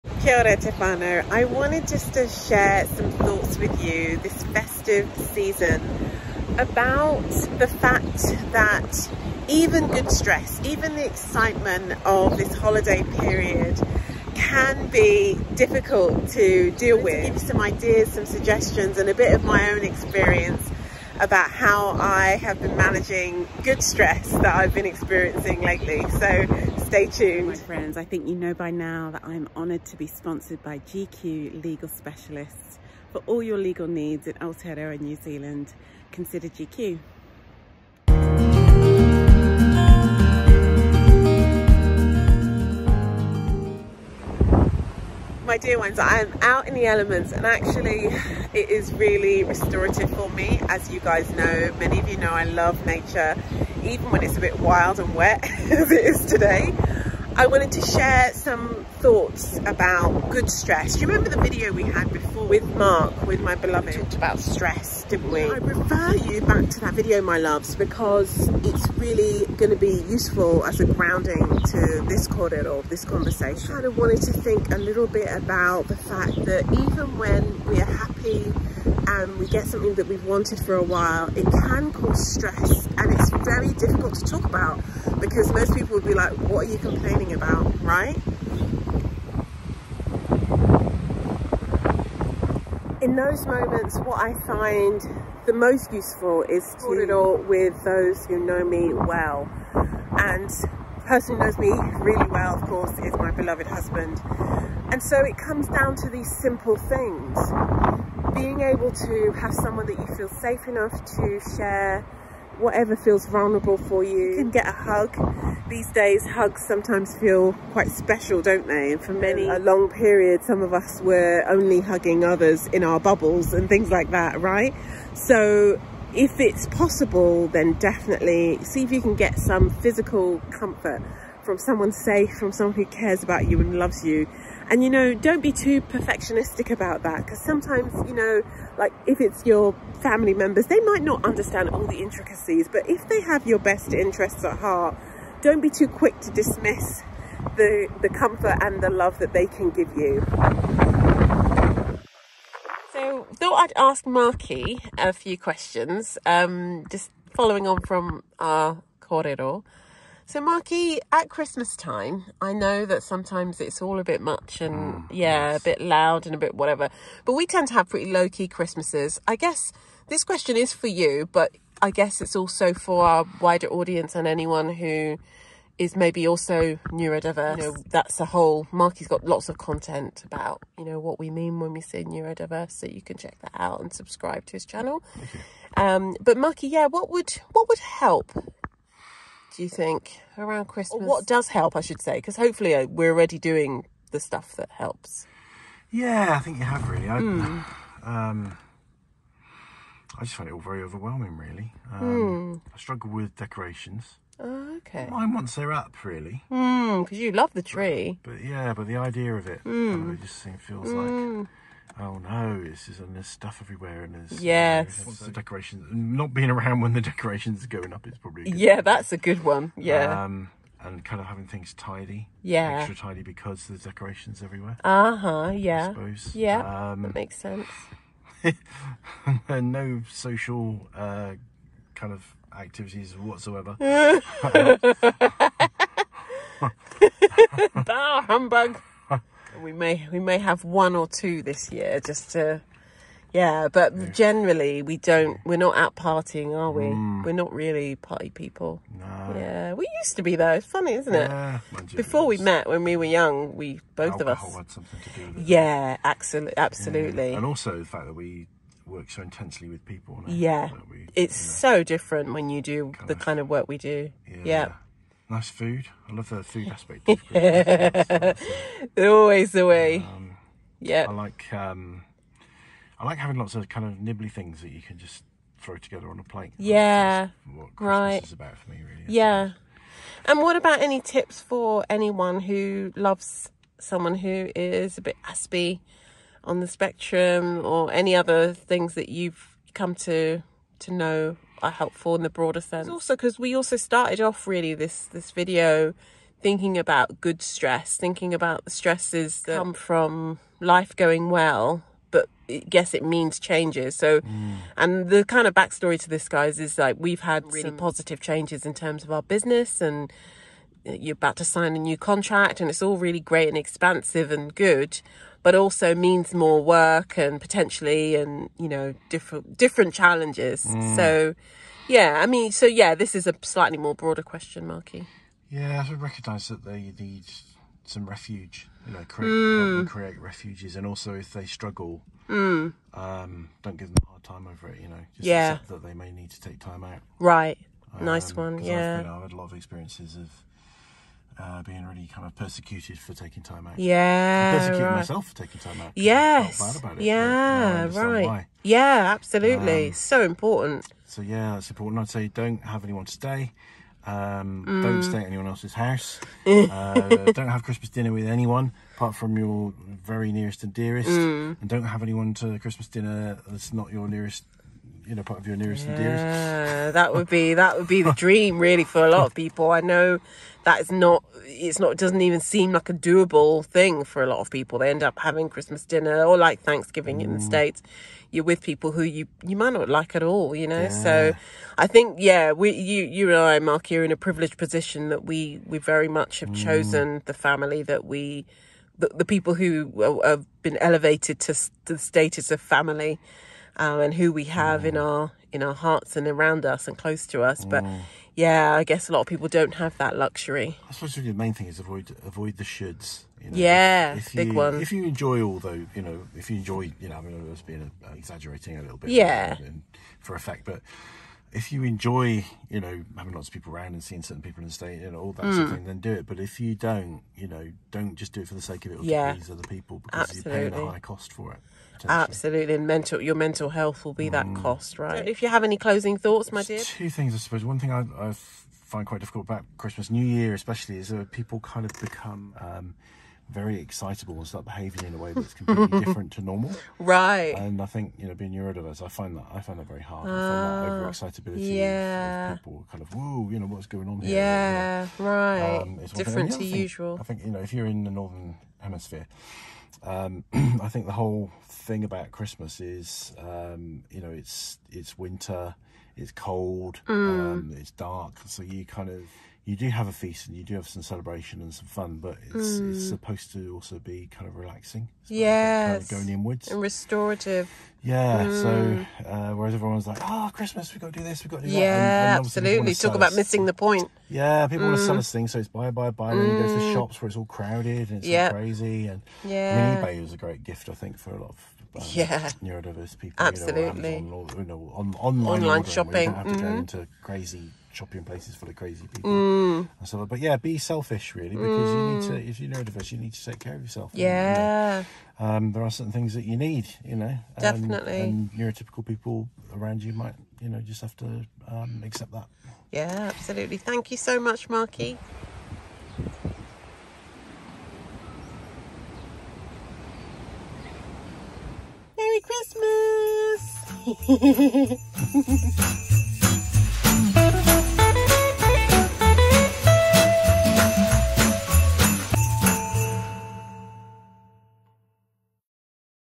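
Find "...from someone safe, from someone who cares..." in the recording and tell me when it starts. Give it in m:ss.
2:11.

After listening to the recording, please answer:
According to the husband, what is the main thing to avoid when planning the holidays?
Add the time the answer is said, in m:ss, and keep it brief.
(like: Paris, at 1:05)
The shoulds, at 6:42.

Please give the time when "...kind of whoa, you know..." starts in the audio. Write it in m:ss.
7:22.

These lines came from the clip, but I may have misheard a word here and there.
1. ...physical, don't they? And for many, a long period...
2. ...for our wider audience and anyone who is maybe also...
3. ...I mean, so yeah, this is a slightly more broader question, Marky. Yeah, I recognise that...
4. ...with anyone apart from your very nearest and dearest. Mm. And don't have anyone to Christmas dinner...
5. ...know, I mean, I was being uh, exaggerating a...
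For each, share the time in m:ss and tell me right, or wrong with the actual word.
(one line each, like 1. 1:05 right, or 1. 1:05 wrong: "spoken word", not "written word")
1. 1:57 wrong: "special", not "physical"
2. 2:52 right
3. 5:22 right
4. 5:58 right
5. 6:47 right.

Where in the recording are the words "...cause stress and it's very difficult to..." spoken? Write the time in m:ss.
1:21.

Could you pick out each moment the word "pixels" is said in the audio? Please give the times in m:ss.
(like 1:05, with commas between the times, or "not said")
not said.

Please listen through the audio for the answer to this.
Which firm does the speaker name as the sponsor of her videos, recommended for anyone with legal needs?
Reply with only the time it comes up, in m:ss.
0:30.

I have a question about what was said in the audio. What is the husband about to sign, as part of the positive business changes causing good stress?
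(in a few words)
A new contract.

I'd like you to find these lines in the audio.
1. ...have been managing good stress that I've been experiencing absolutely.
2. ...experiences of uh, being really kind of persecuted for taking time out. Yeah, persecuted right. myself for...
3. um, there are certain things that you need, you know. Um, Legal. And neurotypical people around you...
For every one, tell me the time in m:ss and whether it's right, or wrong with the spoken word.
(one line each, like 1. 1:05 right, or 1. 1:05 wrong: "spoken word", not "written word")
1. 0:22 wrong: "lately", not "absolutely"
2. 5:39 right
3. 8:15 wrong: "Definitely", not "Legal".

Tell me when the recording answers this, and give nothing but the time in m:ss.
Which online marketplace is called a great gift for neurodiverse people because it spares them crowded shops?
8:00.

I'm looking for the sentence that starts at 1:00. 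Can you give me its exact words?
Do you remember the video we had before with Mark, with my beloved, we talked about stress, didn't we?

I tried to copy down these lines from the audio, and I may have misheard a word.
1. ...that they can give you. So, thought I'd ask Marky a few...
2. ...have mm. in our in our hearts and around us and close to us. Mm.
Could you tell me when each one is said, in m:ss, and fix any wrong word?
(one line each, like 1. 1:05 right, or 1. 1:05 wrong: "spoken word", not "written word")
1. 2:29 right
2. 6:34 right.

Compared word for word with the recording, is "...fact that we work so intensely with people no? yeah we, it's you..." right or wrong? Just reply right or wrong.
right.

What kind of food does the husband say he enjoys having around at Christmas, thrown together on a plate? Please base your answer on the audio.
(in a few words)
Nibbly things.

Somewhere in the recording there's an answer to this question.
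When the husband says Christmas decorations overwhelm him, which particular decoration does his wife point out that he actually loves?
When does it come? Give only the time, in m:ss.
3:27.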